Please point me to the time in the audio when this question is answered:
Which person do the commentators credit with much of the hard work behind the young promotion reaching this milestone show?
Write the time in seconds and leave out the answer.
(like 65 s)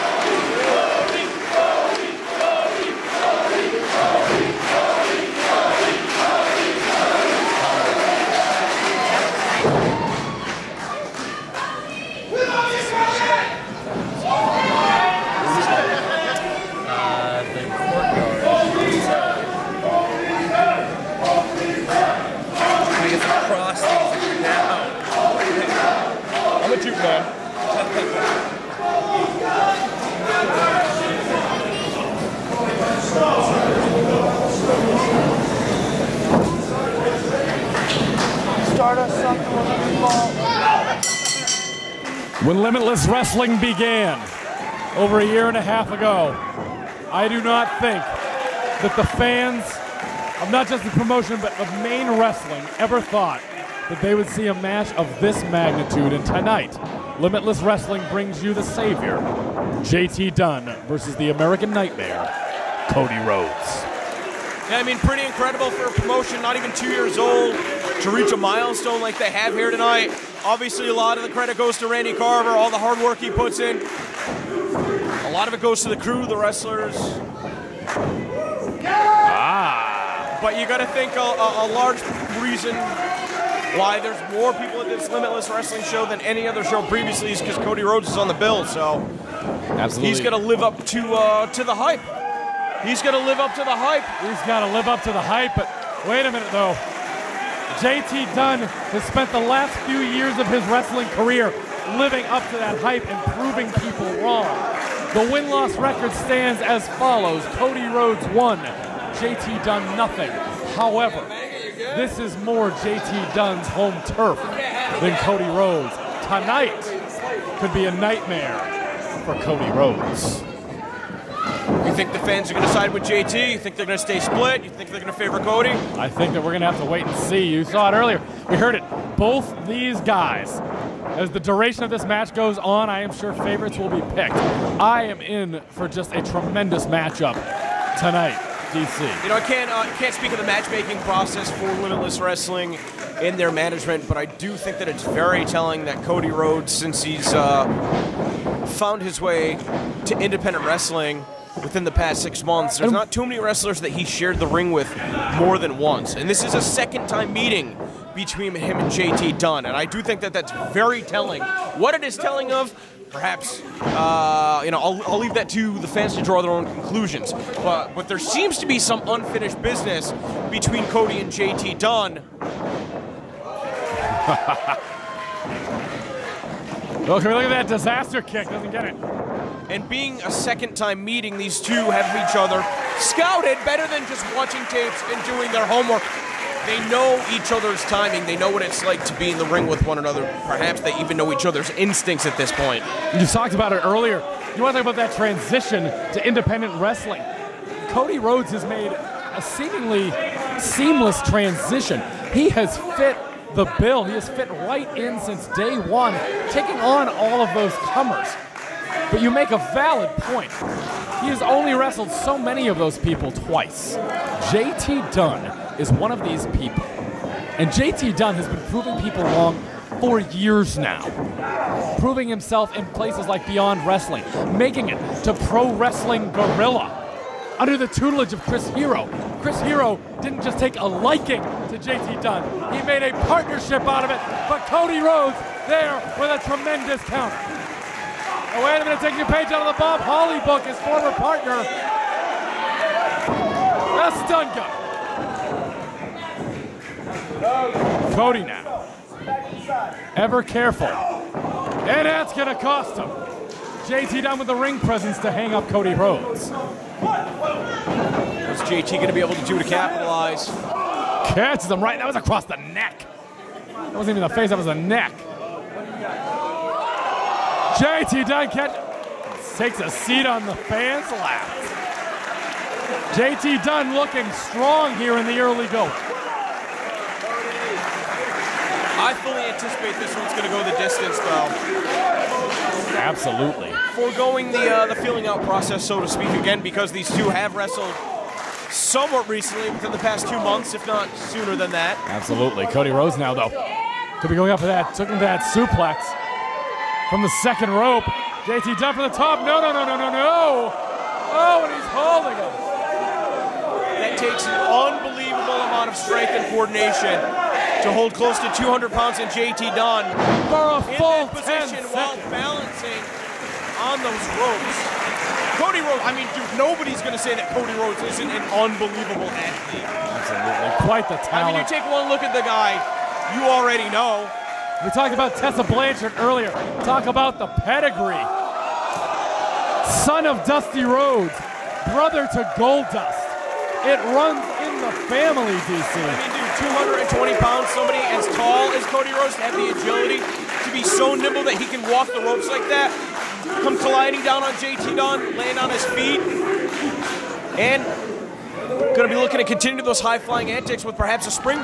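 71 s.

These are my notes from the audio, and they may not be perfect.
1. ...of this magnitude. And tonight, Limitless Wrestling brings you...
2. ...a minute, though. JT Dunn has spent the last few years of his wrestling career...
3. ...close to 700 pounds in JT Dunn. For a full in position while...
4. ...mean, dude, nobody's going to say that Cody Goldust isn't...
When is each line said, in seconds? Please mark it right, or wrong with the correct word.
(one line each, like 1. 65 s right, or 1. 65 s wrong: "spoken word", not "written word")
1. 54 s right
2. 96 s right
3. 308 s wrong: "200", not "700"
4. 316 s wrong: "Rhodes", not "Goldust".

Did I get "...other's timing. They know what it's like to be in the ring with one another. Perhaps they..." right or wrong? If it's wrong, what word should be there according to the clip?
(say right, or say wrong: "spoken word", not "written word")
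right.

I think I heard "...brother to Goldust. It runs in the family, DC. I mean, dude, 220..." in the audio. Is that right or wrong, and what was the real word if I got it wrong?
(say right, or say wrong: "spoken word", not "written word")
right.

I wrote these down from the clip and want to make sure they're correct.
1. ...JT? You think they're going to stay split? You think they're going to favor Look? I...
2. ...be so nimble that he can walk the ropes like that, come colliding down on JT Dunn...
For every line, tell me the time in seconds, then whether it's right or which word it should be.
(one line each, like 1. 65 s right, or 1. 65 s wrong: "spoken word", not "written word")
1. 123 s wrong: "Cody", not "Look"
2. 340 s right.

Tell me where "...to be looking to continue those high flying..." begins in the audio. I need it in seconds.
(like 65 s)
349 s.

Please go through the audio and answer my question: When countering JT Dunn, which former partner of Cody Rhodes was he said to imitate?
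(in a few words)
Bob Holly.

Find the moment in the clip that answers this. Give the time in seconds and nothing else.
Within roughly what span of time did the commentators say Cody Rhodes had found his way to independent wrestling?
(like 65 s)
152 s.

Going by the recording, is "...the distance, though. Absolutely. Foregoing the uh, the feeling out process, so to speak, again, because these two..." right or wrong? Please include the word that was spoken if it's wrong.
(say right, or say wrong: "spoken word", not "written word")
right.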